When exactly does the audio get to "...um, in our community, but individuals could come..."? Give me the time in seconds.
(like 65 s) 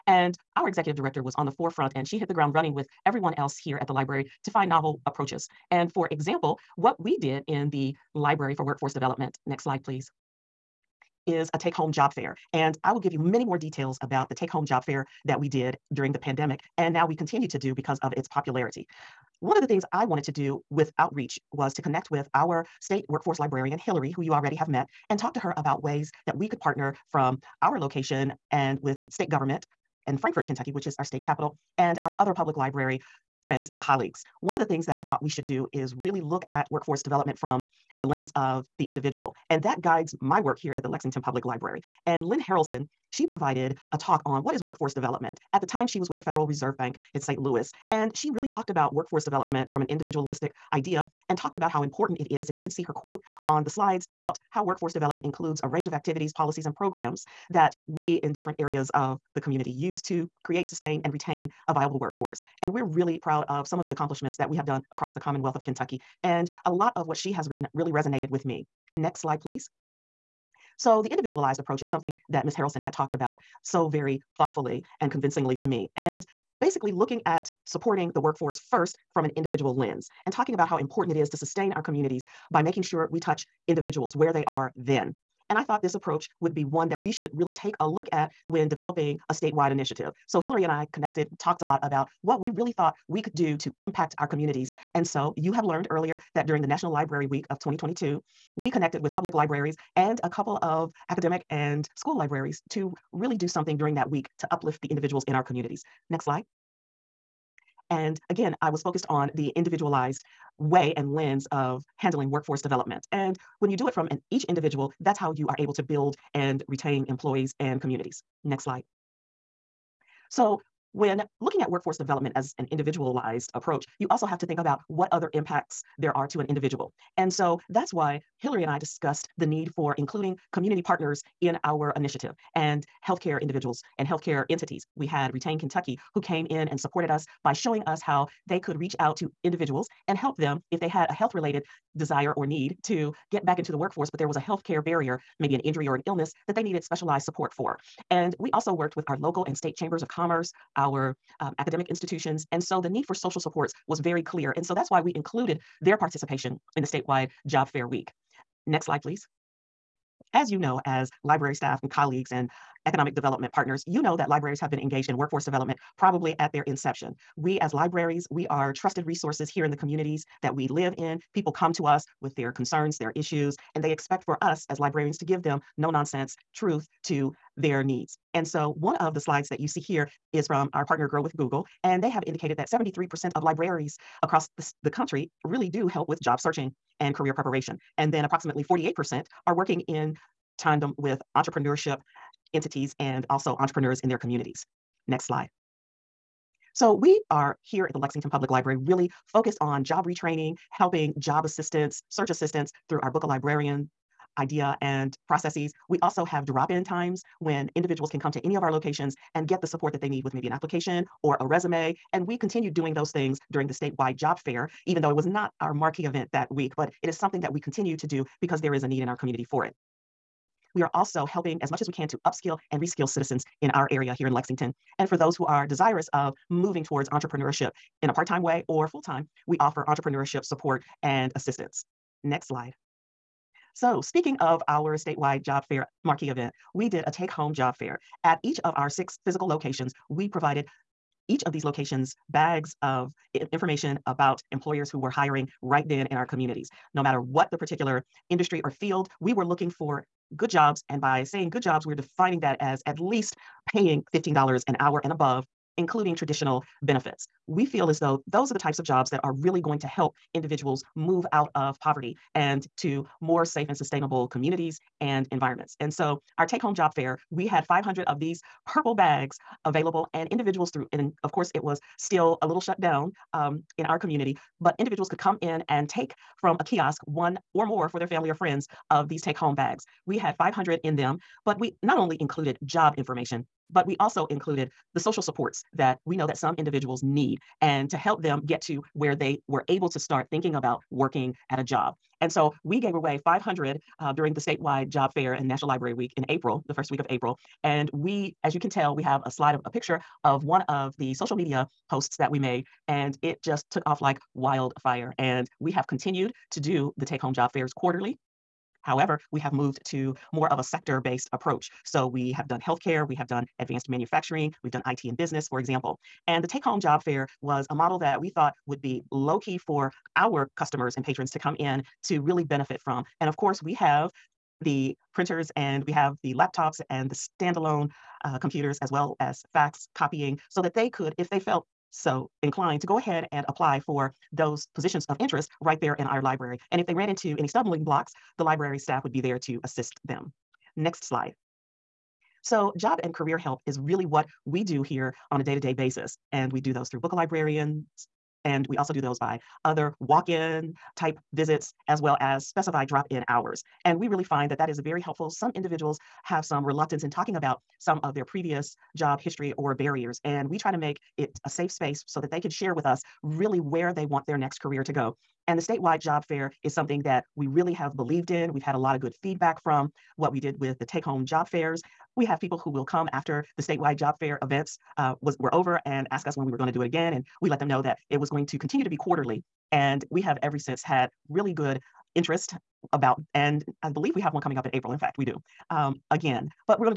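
273 s.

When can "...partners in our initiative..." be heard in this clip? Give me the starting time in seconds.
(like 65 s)
130 s.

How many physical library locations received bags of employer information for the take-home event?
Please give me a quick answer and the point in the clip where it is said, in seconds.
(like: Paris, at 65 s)
6, at 238 s.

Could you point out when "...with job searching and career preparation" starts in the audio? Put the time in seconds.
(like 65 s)
186 s.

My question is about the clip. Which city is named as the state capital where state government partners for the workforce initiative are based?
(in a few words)
Frankfort.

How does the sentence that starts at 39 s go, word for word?
And that guides my work here at the Lexington Public Library.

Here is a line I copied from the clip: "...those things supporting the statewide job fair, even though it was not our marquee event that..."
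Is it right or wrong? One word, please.
wrong.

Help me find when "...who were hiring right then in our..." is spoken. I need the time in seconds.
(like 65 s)
244 s.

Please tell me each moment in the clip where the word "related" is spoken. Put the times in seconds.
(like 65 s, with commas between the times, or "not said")
141 s.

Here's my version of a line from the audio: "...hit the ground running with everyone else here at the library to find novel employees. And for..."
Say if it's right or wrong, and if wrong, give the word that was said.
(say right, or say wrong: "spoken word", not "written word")
wrong: "approaches", not "employees".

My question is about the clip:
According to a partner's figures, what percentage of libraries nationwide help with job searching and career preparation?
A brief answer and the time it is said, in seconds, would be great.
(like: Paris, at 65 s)
73%, at 182 s.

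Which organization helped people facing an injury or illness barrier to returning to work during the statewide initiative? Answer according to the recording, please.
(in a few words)
Retain Kentucky.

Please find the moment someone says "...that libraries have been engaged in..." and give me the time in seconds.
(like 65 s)
164 s.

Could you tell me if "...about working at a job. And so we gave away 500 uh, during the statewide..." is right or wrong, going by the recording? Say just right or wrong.
right.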